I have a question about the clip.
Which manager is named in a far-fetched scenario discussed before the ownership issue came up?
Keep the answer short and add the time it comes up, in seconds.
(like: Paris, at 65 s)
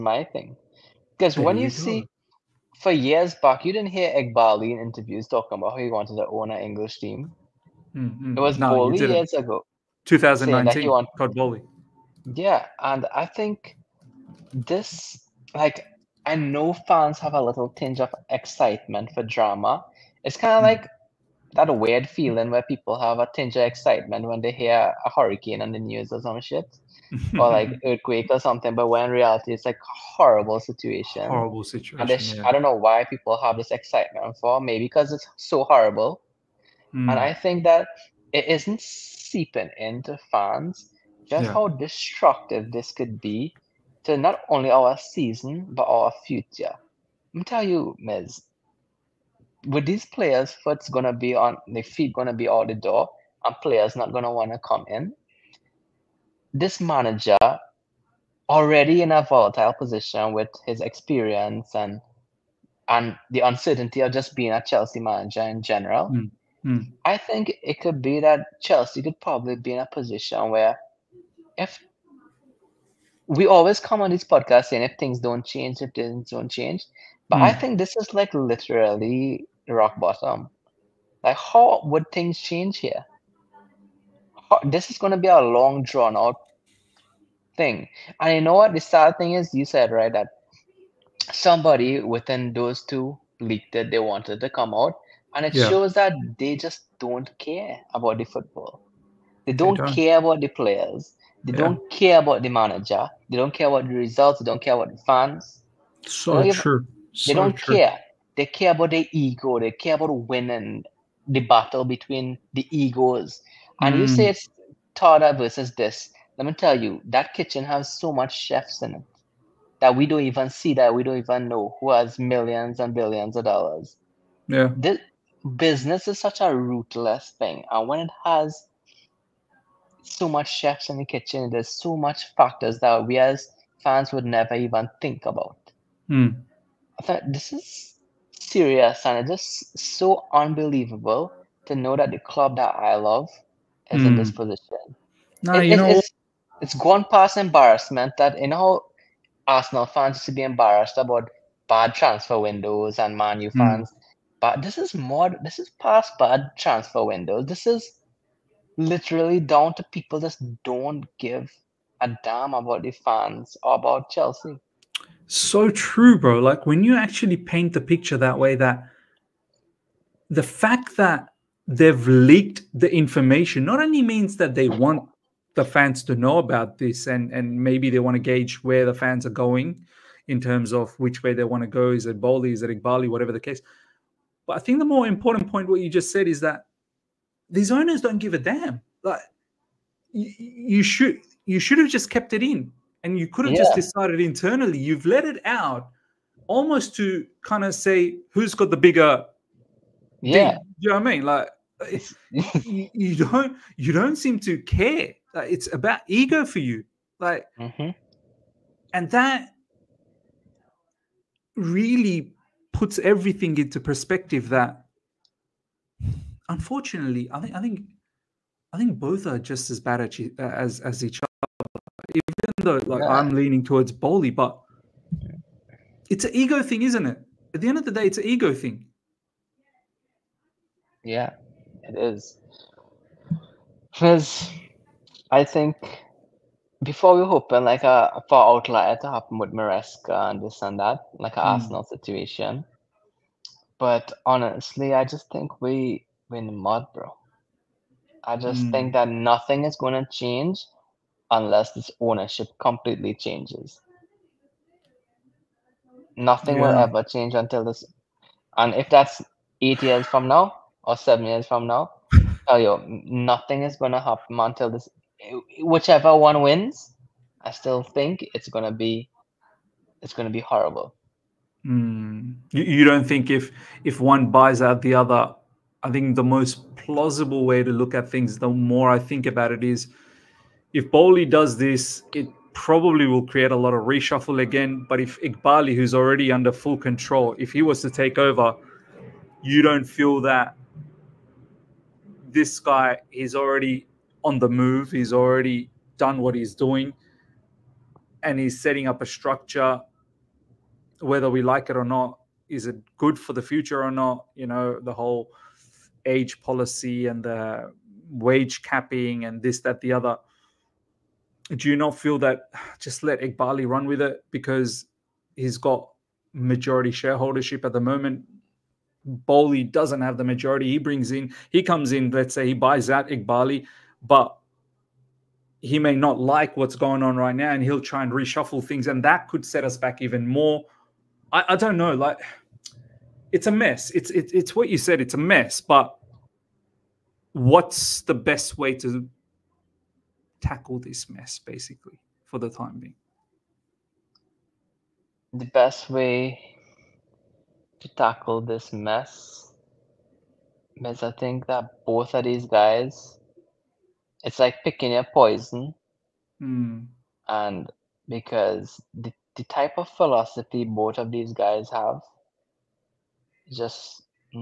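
Maresca, at 239 s.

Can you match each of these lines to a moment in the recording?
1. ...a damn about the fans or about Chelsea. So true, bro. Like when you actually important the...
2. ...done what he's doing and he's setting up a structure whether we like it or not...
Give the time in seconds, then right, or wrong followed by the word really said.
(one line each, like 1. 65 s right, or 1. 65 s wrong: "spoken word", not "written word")
1. 161 s wrong: "paint", not "important"
2. 295 s right.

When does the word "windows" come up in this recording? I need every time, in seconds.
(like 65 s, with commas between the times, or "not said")
152 s, 157 s.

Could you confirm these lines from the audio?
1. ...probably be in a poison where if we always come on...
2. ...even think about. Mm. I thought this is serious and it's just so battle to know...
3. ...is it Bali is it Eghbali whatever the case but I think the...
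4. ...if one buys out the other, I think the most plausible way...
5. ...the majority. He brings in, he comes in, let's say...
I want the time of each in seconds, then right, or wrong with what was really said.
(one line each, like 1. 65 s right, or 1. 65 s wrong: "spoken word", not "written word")
1. 69 s wrong: "position", not "poison"
2. 134 s wrong: "unbelievable", not "battle"
3. 181 s right
4. 273 s right
5. 320 s right.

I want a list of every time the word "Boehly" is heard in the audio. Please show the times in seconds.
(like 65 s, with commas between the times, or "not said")
11 s, 223 s, 280 s, 319 s.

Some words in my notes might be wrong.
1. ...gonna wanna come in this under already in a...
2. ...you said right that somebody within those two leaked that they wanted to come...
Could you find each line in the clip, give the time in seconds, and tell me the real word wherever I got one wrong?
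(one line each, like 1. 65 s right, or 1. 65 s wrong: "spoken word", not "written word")
1. 54 s wrong: "manager", not "under"
2. 89 s right.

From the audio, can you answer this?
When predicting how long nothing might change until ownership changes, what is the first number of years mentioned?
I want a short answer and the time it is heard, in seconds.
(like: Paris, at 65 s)
8, at 259 s.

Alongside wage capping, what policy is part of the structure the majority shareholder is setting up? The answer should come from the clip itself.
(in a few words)
Age policy.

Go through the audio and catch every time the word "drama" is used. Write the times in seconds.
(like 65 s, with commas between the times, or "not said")
19 s.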